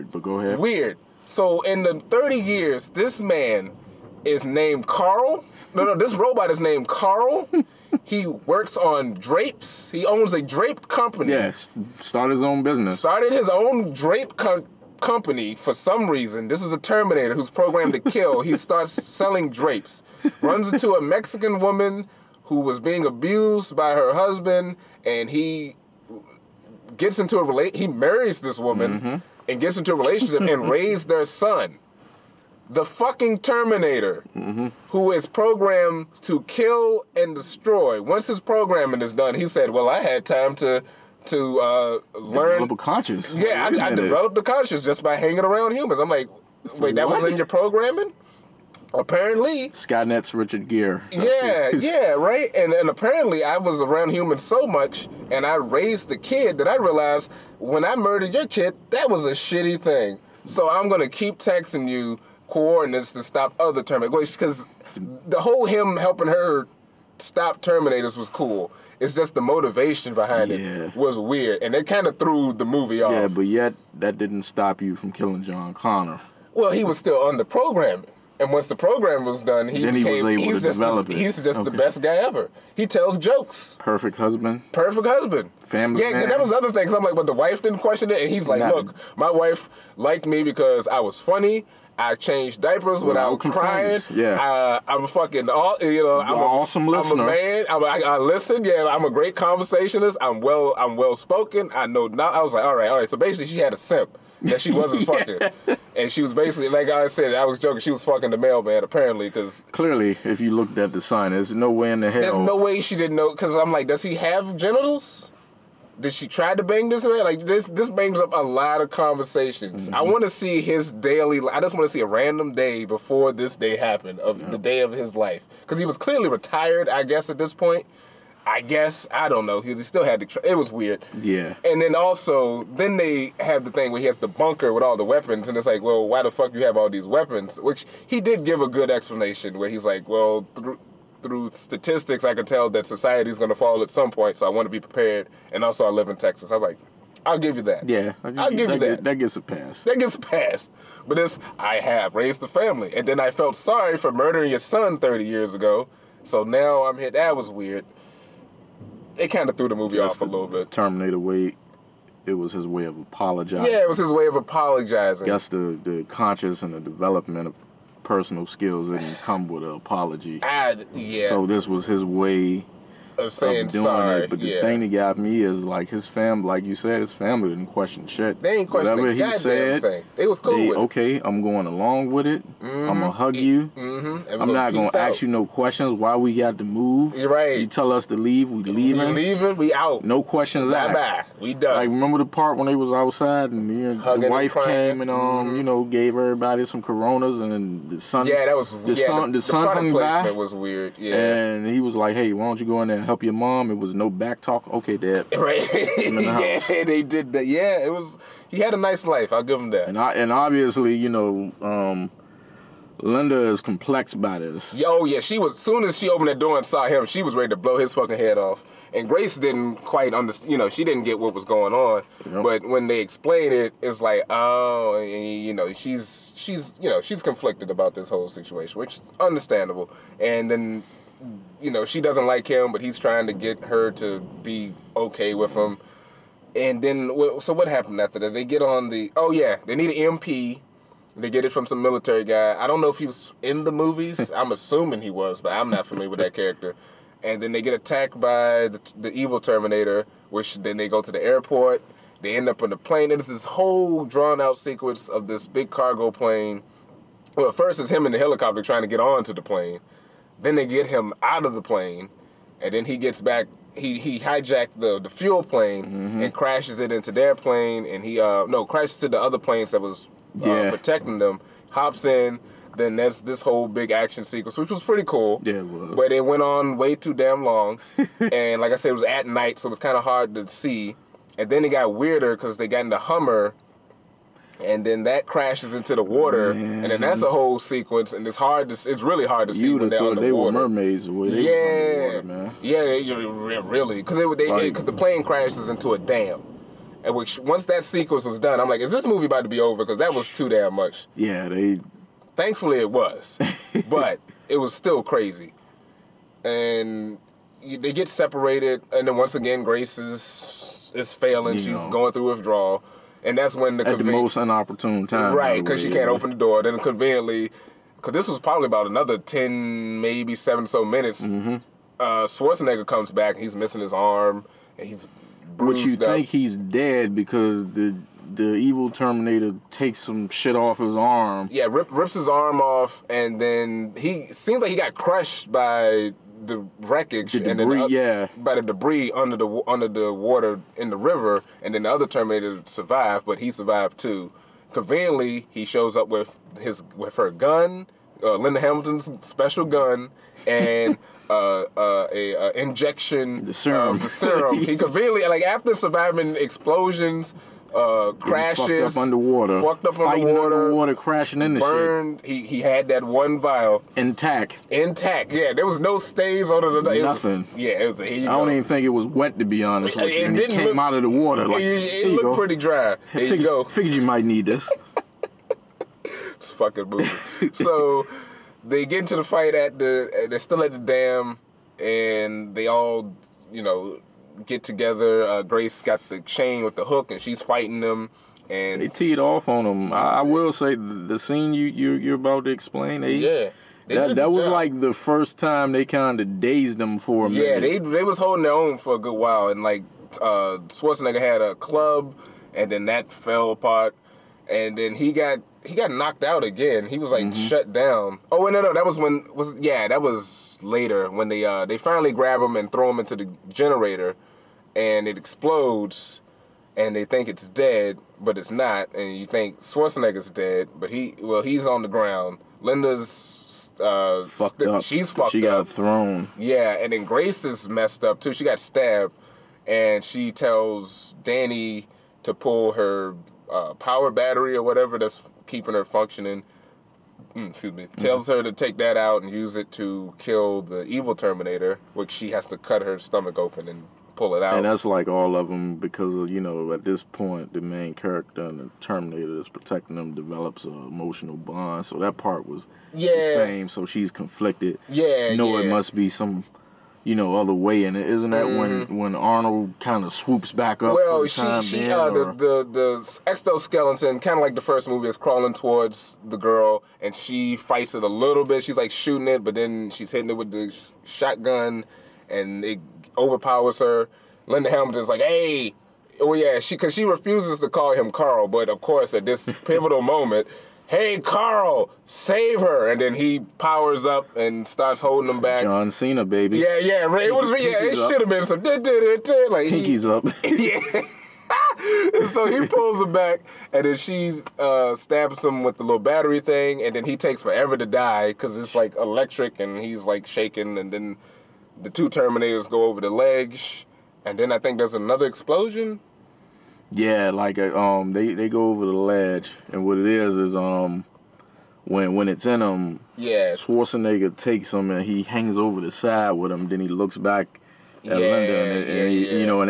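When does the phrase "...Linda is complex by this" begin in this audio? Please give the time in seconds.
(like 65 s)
212 s.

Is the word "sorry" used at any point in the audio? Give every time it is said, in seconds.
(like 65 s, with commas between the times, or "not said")
153 s, 173 s.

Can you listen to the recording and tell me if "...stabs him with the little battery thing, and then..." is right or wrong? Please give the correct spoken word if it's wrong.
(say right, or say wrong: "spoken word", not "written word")
right.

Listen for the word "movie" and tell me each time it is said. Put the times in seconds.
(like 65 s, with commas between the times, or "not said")
72 s, 159 s, 243 s, 299 s, 376 s, 464 s.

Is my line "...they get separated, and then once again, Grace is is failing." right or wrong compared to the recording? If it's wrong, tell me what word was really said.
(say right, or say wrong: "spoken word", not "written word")
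right.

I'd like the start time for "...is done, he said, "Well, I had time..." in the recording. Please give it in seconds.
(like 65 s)
39 s.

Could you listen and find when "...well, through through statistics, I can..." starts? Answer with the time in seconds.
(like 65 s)
140 s.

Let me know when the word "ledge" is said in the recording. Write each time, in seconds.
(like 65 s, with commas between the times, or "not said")
503 s, 508 s.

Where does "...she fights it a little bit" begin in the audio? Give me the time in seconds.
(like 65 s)
467 s.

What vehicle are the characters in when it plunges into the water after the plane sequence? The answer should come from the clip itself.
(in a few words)
Hummer.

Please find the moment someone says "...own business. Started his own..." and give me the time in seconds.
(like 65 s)
12 s.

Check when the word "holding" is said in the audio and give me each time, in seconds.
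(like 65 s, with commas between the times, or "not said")
398 s, 484 s.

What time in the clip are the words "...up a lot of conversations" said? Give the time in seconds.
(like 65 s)
118 s.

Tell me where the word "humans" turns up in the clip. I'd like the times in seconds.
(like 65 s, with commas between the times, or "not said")
45 s, 54 s.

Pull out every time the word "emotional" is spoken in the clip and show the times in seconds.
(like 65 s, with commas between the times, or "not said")
450 s.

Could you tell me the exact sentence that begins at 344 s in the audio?
Conveniently, he shows up with his with her gun, uh, Linda Hamilton's special gun, and.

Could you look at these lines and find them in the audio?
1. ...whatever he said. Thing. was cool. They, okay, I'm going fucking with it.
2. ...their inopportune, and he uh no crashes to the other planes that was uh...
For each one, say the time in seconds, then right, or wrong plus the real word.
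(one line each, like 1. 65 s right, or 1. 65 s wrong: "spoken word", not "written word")
1. 178 s wrong: "along", not "fucking"
2. 267 s wrong: "plane", not "inopportune".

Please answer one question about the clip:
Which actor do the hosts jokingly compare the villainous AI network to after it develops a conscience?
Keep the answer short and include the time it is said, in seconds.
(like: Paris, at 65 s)
Richard Gere, at 50 s.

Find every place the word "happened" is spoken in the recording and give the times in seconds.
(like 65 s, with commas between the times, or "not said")
123 s, 237 s.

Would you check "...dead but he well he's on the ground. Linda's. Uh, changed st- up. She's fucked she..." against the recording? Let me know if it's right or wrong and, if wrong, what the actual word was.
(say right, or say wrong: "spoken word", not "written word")
wrong: "fucked", not "changed".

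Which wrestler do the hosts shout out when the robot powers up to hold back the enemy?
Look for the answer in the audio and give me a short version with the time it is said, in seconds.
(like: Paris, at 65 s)
John Cena, at 485 s.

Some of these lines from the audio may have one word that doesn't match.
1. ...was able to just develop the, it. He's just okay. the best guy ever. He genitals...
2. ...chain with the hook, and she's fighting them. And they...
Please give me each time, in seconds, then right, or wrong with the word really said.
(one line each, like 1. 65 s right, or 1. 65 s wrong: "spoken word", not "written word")
1. 80 s wrong: "tells", not "genitals"
2. 386 s right.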